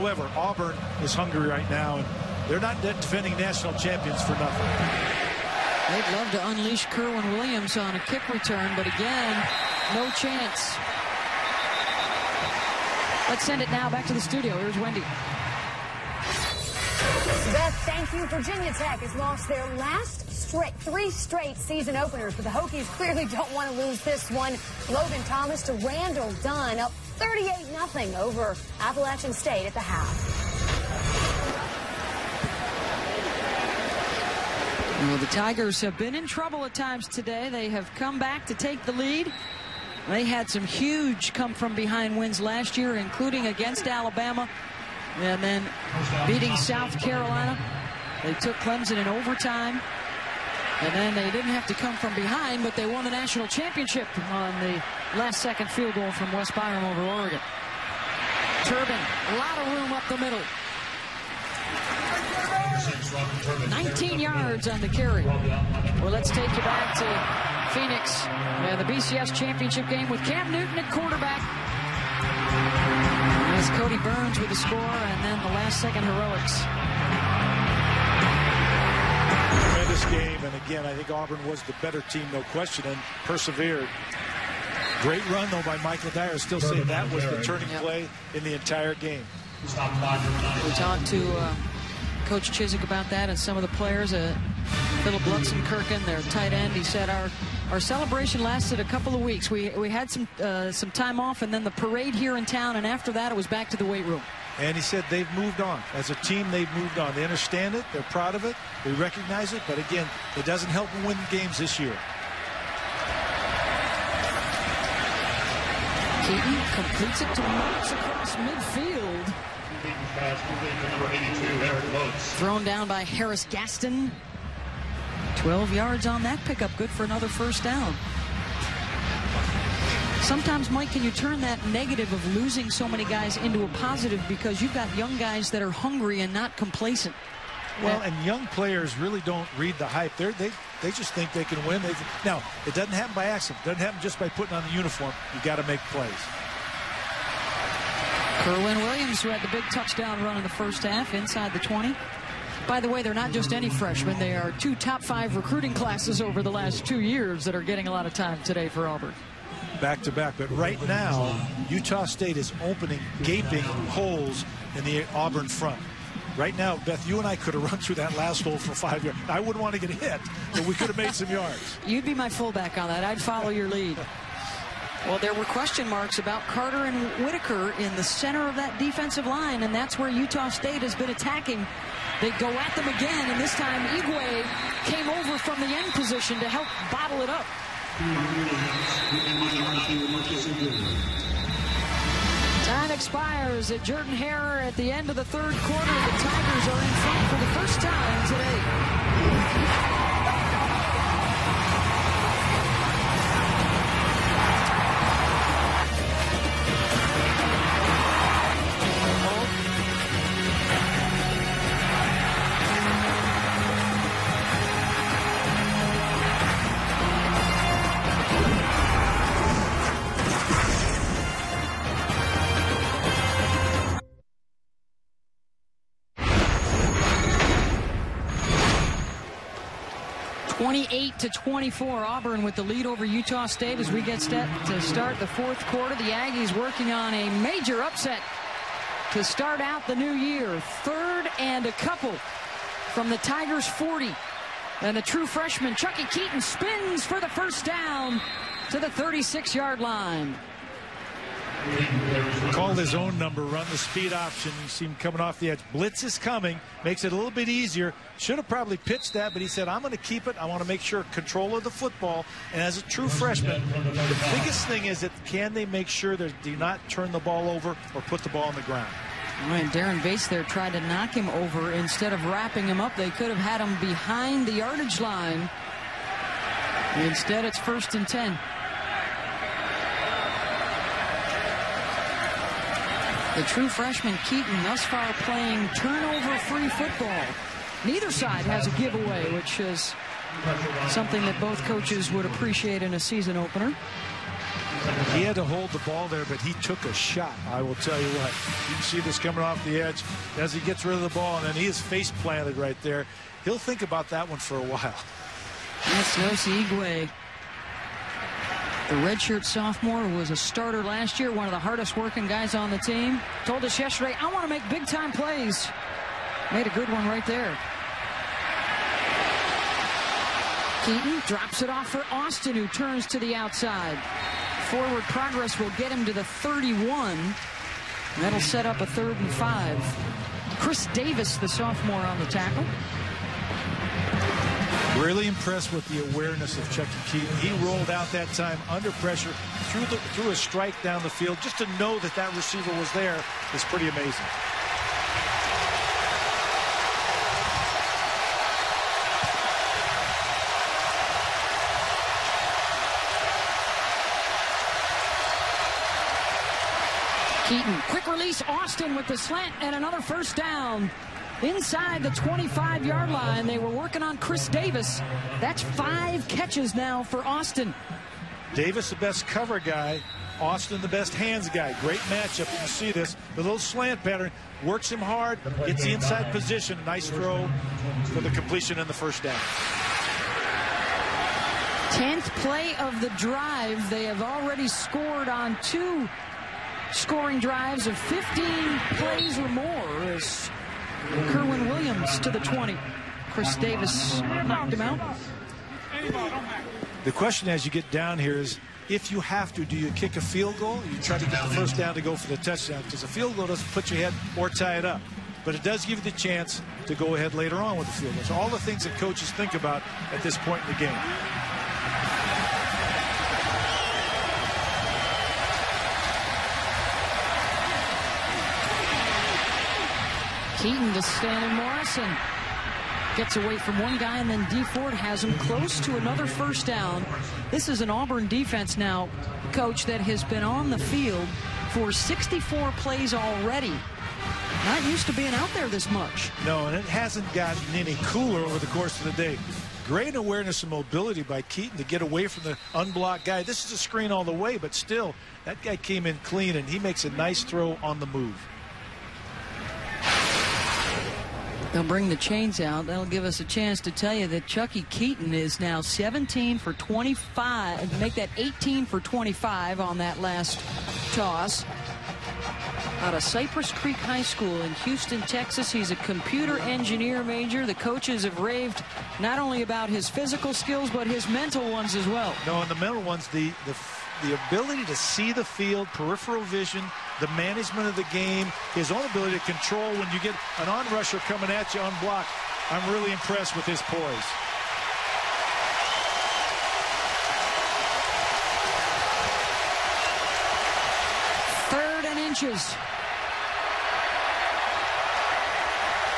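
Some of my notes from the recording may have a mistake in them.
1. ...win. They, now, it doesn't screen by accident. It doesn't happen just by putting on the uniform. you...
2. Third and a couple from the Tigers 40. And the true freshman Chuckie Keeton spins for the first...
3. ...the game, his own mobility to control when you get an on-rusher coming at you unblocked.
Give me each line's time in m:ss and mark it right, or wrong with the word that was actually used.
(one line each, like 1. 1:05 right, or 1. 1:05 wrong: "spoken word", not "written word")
1. 2:21 wrong: "happen", not "screen"
2. 4:00 right
3. 7:57 wrong: "ability", not "mobility".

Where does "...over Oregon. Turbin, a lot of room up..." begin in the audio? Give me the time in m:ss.
0:56.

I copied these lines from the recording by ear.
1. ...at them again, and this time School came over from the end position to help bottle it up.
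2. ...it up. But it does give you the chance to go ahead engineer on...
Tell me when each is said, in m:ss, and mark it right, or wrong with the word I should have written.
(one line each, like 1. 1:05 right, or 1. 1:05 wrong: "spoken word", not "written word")
1. 3:02 wrong: "Eguae", not "School"
2. 6:44 wrong: "later", not "engineer".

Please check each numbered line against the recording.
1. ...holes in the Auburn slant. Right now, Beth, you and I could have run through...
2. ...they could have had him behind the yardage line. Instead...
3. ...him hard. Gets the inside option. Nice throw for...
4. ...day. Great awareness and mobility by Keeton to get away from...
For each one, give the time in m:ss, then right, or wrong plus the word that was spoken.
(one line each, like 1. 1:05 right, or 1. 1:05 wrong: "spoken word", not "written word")
1. 2:43 wrong: "front", not "slant"
2. 4:32 right
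3. 6:14 wrong: "position", not "option"
4. 7:19 right.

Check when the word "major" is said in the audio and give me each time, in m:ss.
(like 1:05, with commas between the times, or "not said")
3:57, 7:47.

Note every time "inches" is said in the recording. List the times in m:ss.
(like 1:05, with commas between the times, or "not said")
8:12.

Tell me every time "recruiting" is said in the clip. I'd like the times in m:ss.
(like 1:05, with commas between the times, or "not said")
2:35.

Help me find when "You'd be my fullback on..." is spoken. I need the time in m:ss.
2:51.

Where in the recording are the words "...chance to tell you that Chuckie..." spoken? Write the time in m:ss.
7:33.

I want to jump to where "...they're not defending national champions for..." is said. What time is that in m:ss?
0:02.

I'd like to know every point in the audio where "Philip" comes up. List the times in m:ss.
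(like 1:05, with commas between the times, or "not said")
1:35.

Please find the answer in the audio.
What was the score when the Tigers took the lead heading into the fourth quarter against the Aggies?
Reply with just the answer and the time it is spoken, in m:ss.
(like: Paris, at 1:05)
28 to 24, at 3:50.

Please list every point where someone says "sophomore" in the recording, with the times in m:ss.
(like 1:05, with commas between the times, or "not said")
5:09, 5:31.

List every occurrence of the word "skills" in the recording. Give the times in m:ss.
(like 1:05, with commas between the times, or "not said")
7:50.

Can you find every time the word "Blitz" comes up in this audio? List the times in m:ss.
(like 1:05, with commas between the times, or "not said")
4:15.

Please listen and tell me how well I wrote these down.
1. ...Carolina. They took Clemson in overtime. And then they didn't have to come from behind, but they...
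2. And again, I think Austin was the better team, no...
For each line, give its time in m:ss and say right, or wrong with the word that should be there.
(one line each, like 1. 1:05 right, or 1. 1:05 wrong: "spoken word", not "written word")
1. 0:47 right
2. 1:20 wrong: "Auburn", not "Austin".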